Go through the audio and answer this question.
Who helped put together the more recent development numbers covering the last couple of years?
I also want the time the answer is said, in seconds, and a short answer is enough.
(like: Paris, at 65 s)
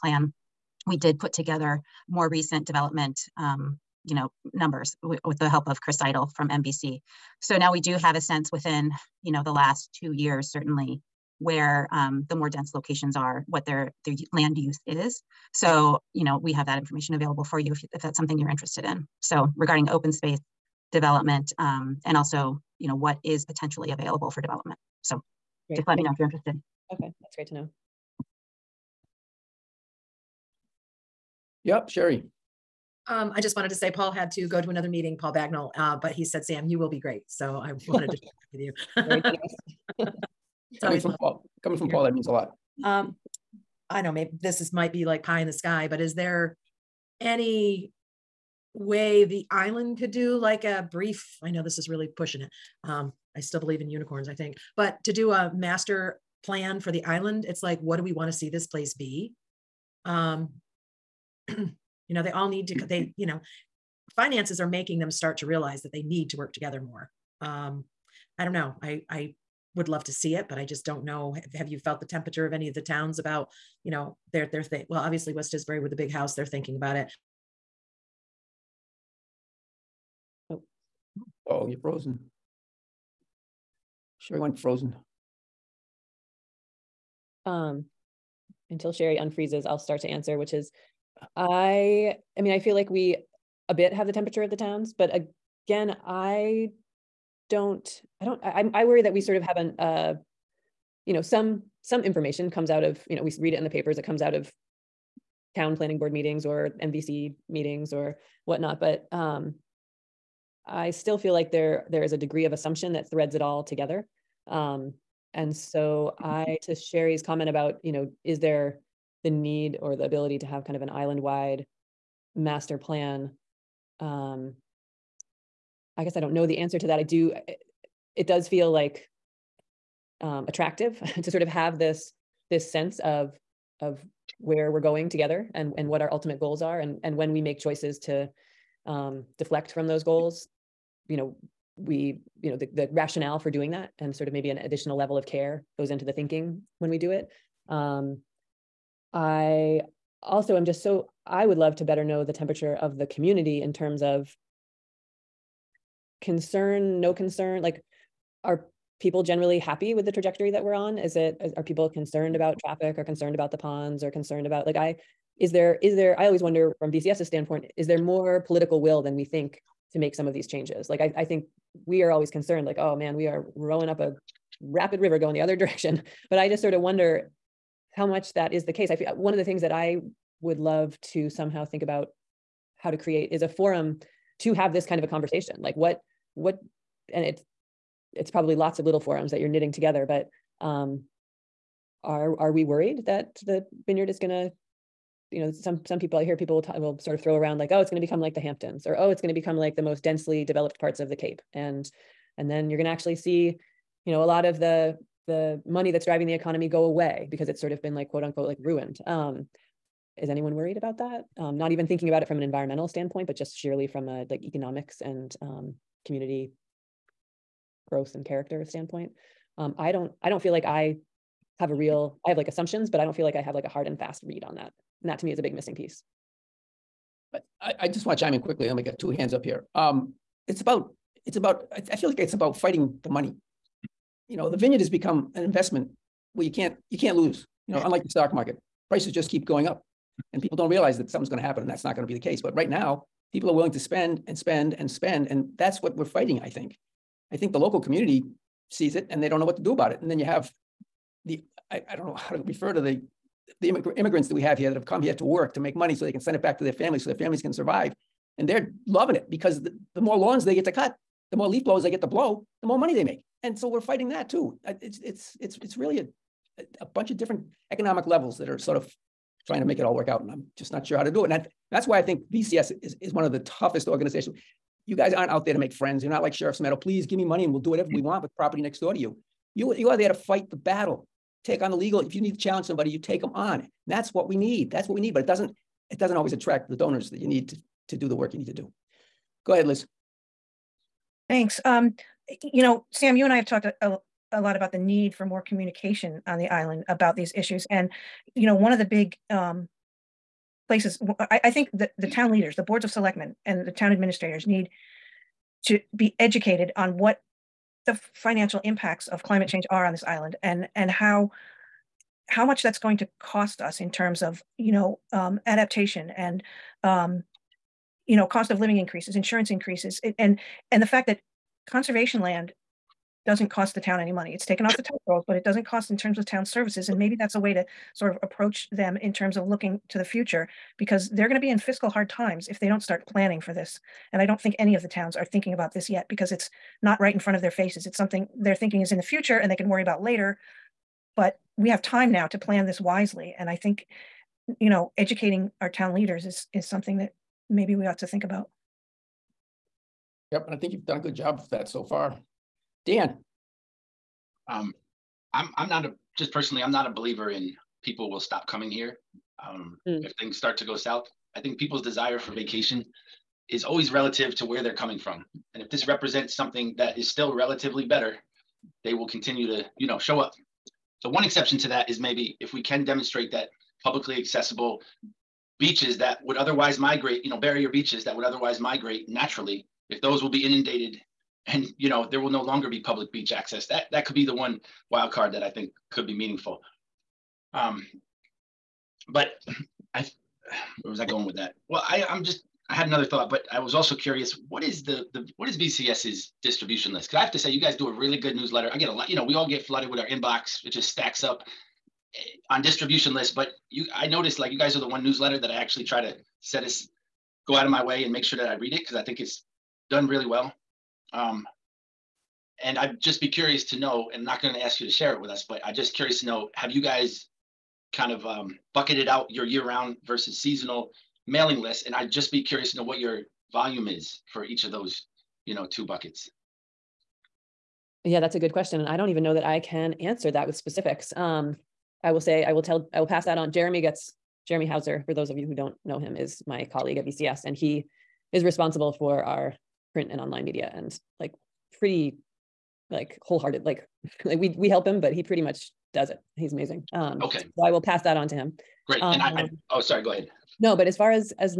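Chris Seidel, at 5 s.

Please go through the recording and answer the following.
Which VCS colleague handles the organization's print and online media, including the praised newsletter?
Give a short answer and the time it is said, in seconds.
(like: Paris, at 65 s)
Jeremy Hauser, at 434 s.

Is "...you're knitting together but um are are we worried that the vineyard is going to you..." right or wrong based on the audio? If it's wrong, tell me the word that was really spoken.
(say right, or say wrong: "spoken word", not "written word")
right.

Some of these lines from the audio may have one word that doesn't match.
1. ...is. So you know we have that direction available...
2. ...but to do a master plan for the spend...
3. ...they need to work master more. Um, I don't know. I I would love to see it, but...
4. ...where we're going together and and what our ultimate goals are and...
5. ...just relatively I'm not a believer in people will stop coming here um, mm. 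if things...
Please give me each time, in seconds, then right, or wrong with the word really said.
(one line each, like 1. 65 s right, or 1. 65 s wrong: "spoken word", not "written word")
1. 14 s wrong: "information", not "direction"
2. 54 s wrong: "island", not "spend"
3. 65 s wrong: "together", not "master"
4. 134 s right
5. 356 s wrong: "personally", not "relatively".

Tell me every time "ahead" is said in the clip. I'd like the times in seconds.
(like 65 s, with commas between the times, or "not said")
289 s, 450 s.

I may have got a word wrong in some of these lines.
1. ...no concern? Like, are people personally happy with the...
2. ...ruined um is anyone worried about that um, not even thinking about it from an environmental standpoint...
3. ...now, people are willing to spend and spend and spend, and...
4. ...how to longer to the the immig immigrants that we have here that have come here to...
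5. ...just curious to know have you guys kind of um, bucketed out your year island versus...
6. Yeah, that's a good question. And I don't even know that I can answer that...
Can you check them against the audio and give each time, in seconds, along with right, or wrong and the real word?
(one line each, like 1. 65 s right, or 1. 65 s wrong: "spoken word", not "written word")
1. 156 s wrong: "generally", not "personally"
2. 208 s right
3. 242 s right
4. 252 s wrong: "refer", not "longer"
5. 415 s wrong: "round", not "island"
6. 428 s right.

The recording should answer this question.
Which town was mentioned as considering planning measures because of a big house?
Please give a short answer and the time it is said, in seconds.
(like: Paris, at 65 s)
West Tisbury, at 75 s.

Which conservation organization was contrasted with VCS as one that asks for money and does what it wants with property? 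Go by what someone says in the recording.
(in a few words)
Sheriff's Meadow.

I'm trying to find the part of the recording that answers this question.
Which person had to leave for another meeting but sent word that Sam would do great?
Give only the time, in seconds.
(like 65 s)
35 s.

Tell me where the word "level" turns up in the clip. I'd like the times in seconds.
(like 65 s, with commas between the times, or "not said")
144 s, 268 s.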